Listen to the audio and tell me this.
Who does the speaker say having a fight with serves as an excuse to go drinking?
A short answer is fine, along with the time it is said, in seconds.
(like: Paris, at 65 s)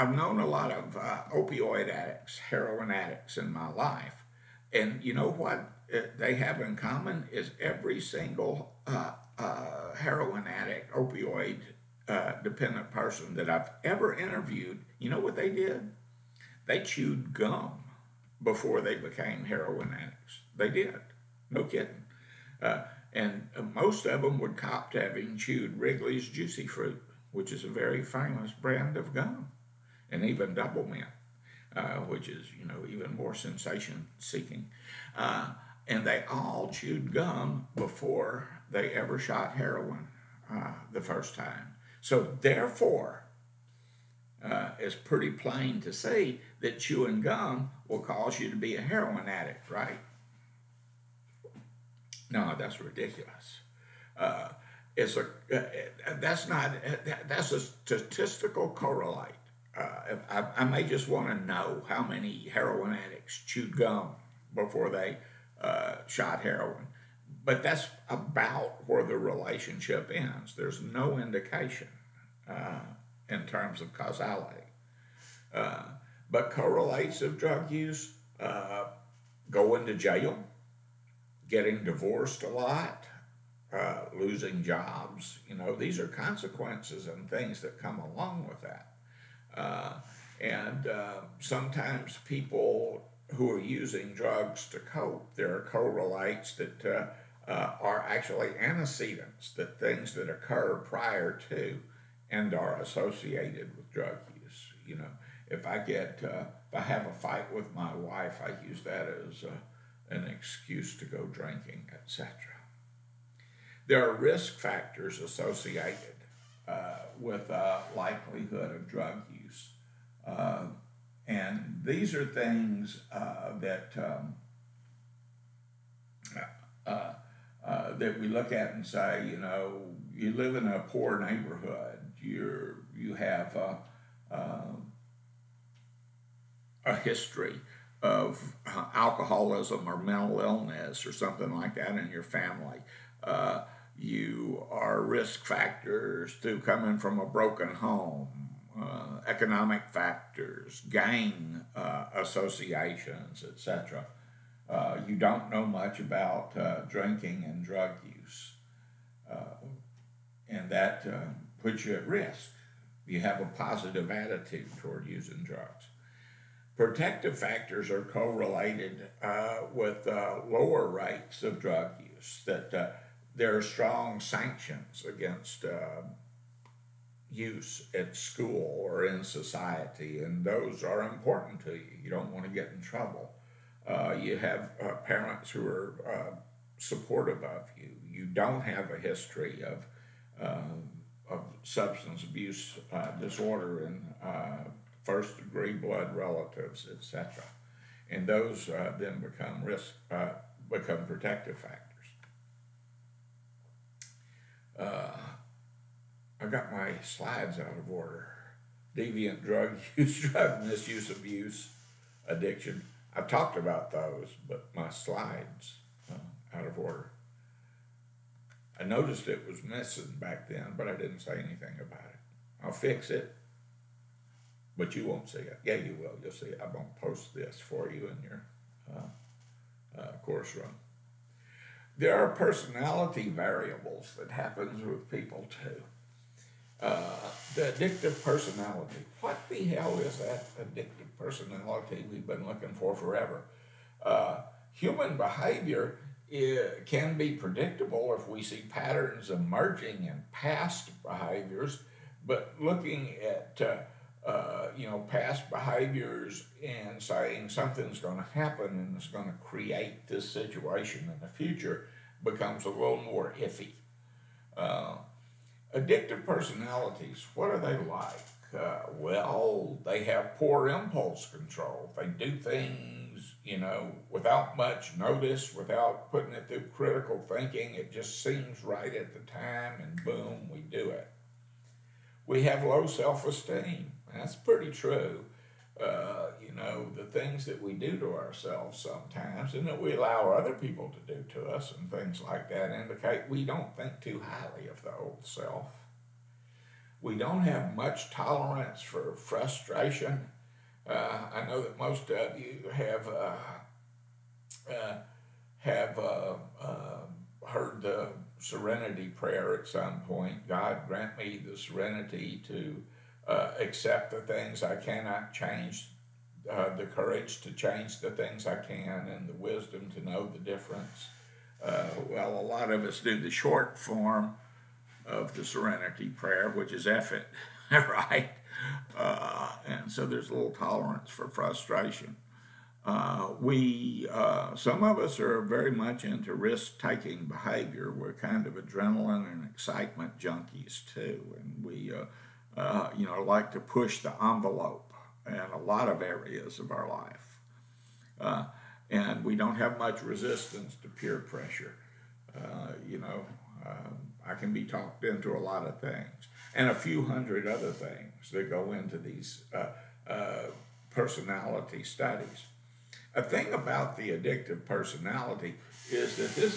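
my wife, at 107 s.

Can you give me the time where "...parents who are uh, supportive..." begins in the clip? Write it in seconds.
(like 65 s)
185 s.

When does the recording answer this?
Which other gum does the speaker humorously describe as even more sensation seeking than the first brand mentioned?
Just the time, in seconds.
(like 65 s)
30 s.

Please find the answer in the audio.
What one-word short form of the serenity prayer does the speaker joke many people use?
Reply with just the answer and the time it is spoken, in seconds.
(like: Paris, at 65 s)
effort, at 326 s.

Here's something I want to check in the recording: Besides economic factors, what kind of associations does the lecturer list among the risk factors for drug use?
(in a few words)
gang.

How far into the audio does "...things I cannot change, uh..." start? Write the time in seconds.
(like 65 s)
314 s.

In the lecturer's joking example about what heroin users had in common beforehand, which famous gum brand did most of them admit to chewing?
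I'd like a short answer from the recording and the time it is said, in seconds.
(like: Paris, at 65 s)
Wrigley's Juicy Fruit, at 25 s.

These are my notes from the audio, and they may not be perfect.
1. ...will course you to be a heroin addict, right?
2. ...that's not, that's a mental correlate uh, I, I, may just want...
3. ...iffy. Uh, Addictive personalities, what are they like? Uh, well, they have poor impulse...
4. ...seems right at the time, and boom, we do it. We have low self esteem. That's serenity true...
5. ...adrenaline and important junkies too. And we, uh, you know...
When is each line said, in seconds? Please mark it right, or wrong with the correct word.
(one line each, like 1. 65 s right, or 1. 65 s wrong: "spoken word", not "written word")
1. 47 s wrong: "cause", not "course"
2. 56 s wrong: "statistical", not "mental"
3. 263 s right
4. 278 s wrong: "pretty", not "serenity"
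5. 338 s wrong: "excitement", not "important".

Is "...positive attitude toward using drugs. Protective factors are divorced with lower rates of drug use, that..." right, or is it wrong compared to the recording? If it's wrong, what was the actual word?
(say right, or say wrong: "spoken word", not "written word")
wrong: "correlated", not "divorced".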